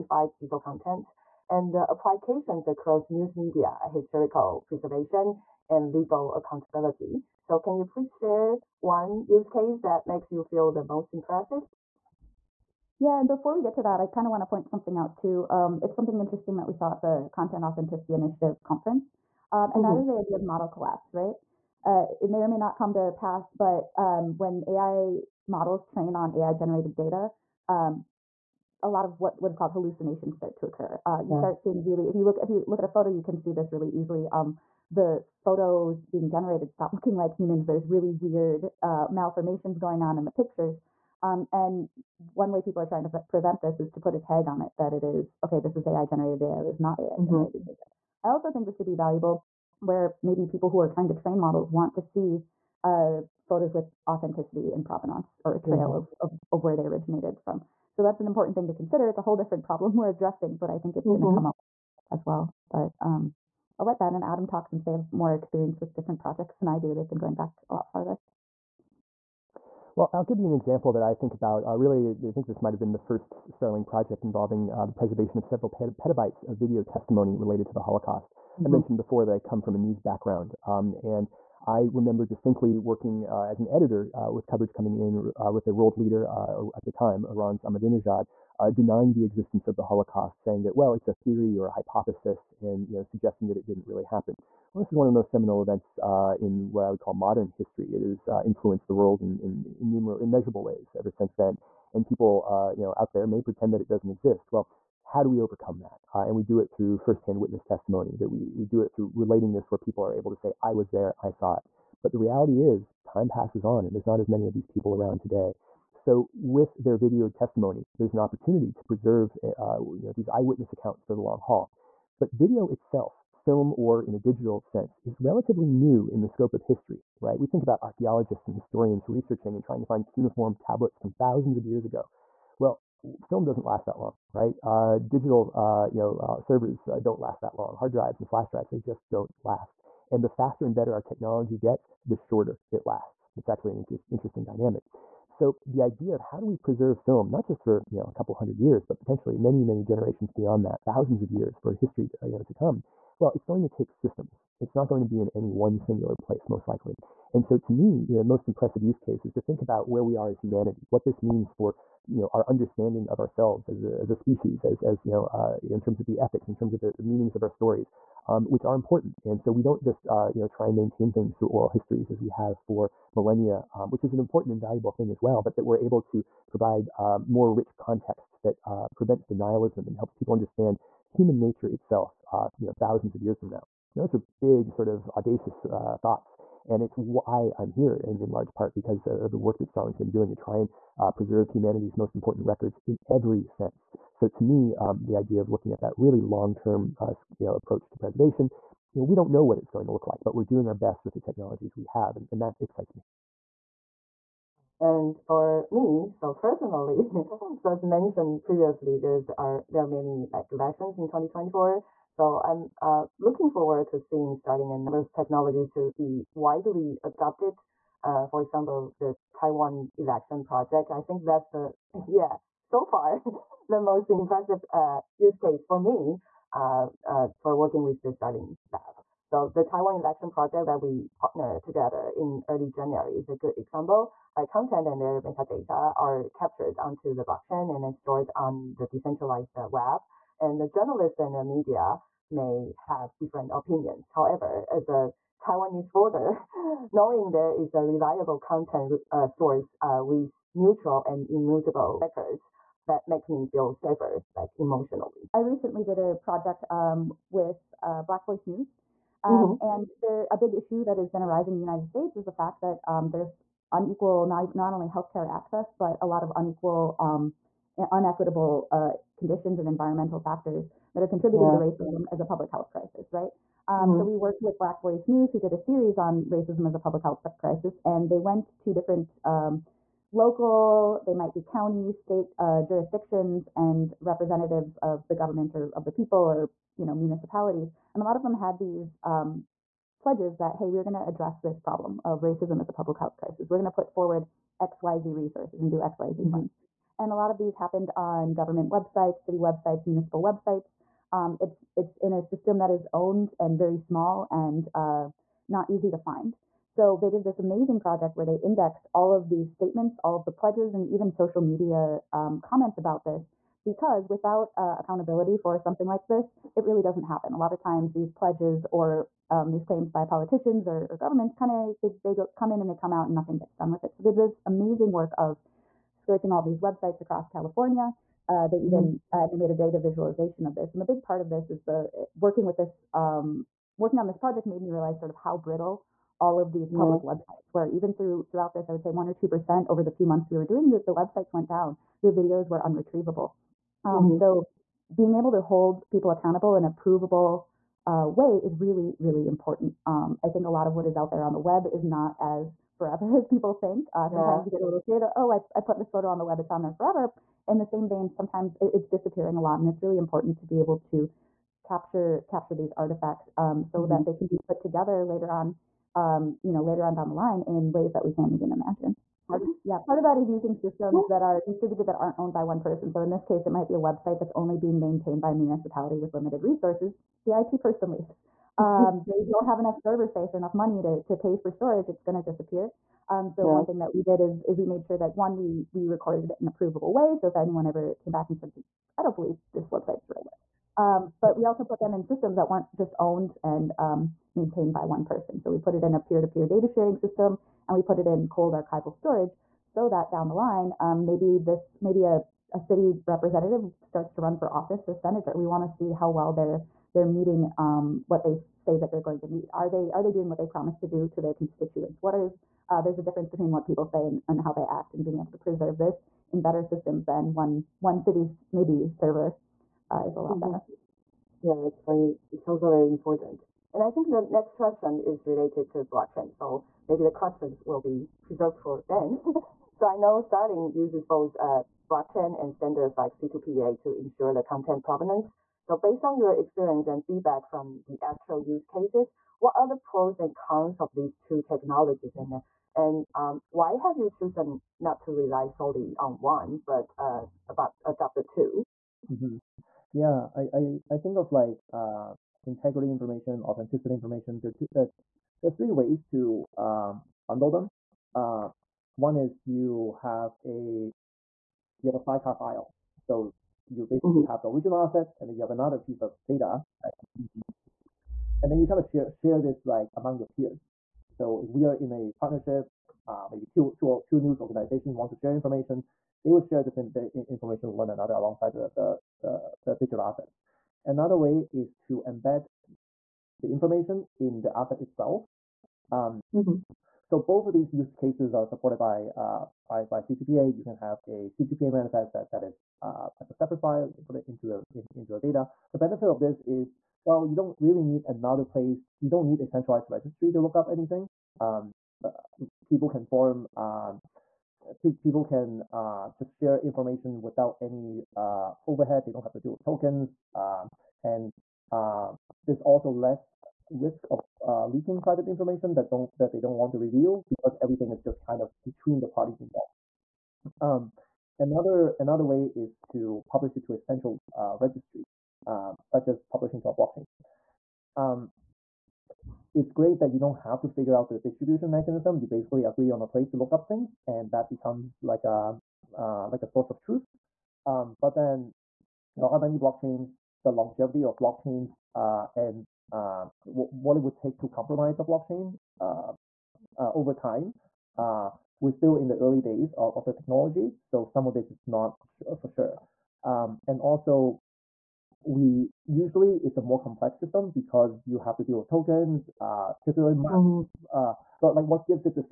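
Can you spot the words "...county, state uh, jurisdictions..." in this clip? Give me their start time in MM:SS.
04:41.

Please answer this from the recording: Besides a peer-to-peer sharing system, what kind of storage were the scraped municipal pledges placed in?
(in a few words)
Cold archival storage.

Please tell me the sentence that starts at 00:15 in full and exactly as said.
Um, it's something interesting that we saw at the Content Authenticity Initiative conference, um, and that mm-hmm.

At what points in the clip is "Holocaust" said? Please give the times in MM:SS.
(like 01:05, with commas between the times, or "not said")
01:17, 01:29.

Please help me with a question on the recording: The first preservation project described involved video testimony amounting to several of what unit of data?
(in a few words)
Petabytes.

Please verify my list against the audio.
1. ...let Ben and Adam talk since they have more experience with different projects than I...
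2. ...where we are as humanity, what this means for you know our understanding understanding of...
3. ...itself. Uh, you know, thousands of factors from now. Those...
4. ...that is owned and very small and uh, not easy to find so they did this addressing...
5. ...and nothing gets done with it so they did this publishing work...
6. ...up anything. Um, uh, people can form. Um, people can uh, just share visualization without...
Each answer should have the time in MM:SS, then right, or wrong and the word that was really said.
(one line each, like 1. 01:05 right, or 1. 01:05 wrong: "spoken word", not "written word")
1. 01:03 right
2. 02:39 right
3. 03:01 wrong: "years", not "factors"
4. 05:02 wrong: "amazing", not "addressing"
5. 05:23 wrong: "amazing", not "publishing"
6. 08:20 wrong: "information", not "visualization".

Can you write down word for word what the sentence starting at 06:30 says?
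Um, but we also put them in systems that weren't just owned and um, maintained by one person.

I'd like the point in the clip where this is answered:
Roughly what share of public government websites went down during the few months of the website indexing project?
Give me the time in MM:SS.
05:38.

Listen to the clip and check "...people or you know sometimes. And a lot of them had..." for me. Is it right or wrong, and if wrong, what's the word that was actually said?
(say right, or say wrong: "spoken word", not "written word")
wrong: "municipalities", not "sometimes".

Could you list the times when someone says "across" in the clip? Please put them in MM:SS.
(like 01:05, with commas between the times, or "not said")
00:02, 05:27.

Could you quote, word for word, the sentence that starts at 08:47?
Um, it's great that you don't have to figure out the distribution mechanism.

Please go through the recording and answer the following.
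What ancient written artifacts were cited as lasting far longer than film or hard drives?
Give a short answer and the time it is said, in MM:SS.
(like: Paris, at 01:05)
Cuneiform tablets, at 02:10.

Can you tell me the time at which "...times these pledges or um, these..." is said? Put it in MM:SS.
05:17.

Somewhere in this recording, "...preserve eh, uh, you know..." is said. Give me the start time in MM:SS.
01:58.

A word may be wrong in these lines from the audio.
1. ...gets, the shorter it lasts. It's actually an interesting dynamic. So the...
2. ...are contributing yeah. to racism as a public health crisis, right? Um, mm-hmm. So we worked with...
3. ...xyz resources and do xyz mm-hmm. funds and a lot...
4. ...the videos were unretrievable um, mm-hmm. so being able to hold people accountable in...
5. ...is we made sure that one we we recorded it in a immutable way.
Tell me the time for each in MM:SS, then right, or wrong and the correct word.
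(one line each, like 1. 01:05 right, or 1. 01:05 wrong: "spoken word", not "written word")
1. 02:21 right
2. 04:31 right
3. 04:54 right
4. 05:42 right
5. 06:24 wrong: "provable", not "immutable".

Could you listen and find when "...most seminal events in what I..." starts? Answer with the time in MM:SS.
01:35.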